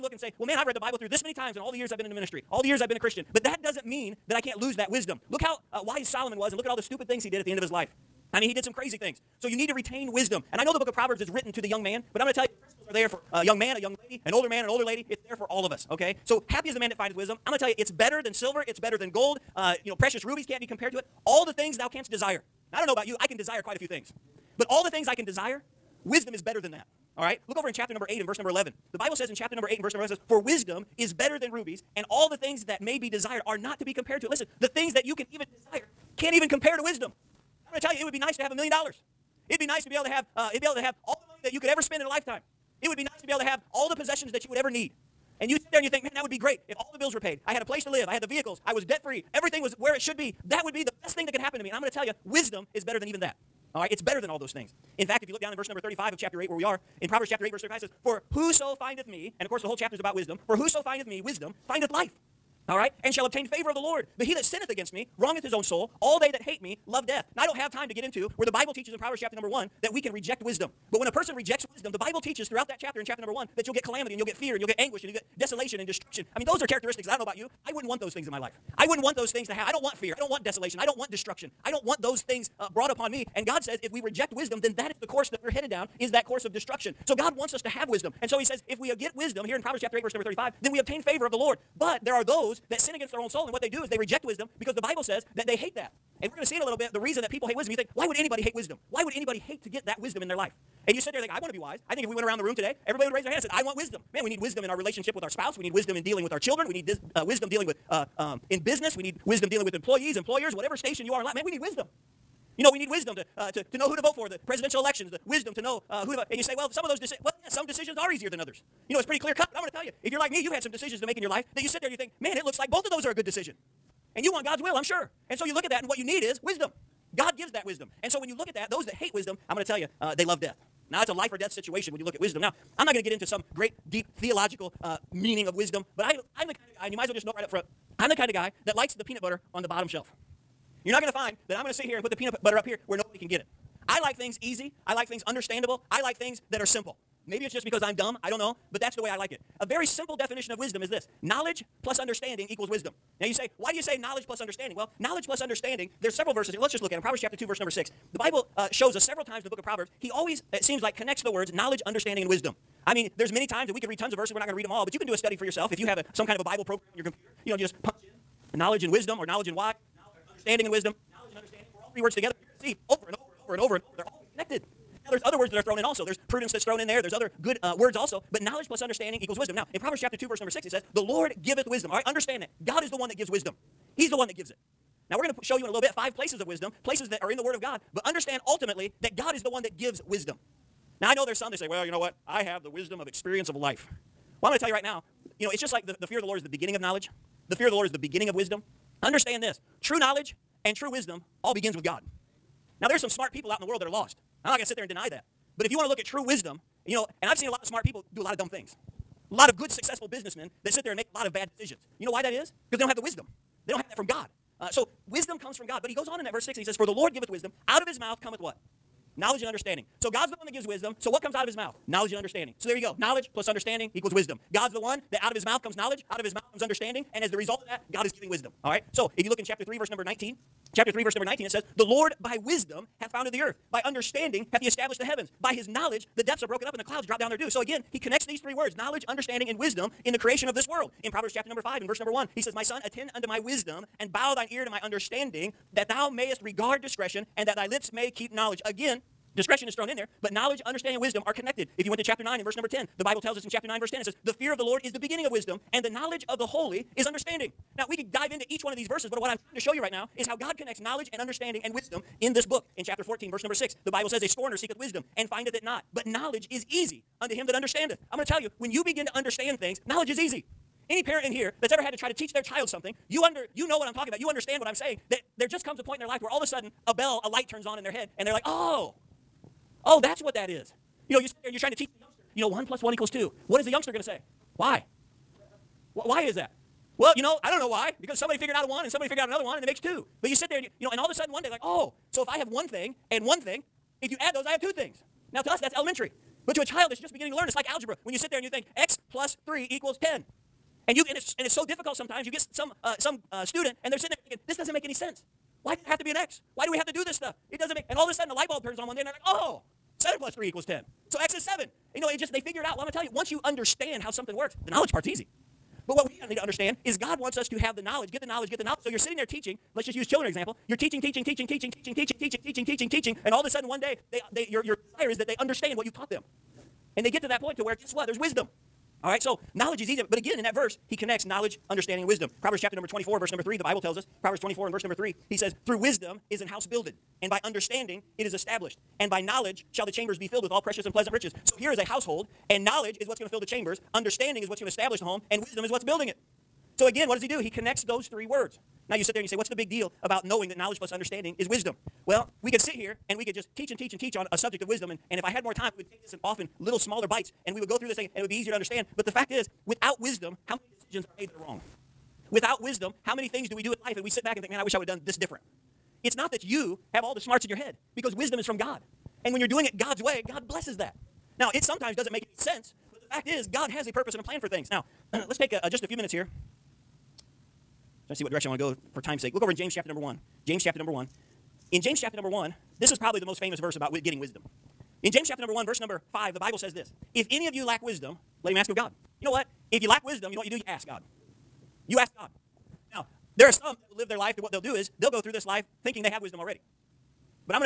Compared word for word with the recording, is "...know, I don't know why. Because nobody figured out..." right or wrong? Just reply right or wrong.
wrong.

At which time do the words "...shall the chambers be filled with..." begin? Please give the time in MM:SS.
05:39.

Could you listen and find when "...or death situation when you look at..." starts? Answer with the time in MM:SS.
02:11.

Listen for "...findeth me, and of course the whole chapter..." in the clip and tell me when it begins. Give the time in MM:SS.
00:58.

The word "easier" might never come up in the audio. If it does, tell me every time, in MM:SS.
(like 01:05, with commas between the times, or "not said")
01:58, 05:58.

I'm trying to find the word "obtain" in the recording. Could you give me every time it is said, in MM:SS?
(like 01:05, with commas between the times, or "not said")
01:03, 01:30.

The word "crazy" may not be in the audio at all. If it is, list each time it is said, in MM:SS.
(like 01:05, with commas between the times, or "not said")
00:08.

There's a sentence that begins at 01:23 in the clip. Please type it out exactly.
And God says if we reject wisdom, then that is the course that we're headed down, is that course of destruction.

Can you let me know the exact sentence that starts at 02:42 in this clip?
I mean, there's many times that we could read tons of verses.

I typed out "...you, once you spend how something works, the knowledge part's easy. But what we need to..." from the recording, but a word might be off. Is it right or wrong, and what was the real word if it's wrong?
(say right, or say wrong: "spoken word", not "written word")
wrong: "understand", not "spend".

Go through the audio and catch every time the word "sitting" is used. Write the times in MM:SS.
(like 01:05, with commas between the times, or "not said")
05:03, 05:18.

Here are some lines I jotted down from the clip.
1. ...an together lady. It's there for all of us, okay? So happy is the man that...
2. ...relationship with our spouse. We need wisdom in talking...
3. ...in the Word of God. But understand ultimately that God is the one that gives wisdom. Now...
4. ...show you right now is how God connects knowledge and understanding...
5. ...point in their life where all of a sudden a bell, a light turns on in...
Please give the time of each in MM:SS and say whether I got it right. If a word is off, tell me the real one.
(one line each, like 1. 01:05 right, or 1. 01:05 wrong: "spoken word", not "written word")
1. 00:14 wrong: "older", not "together"
2. 01:44 wrong: "dealing", not "talking"
3. 03:07 right
4. 04:19 right
5. 04:35 right.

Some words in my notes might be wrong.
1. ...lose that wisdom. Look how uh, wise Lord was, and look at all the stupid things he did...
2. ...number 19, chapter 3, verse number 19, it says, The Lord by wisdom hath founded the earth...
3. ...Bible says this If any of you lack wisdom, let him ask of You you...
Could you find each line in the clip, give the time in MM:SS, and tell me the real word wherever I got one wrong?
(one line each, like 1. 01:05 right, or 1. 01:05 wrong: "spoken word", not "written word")
1. 00:04 wrong: "Solomon", not "Lord"
2. 03:49 right
3. 06:26 wrong: "God", not "You".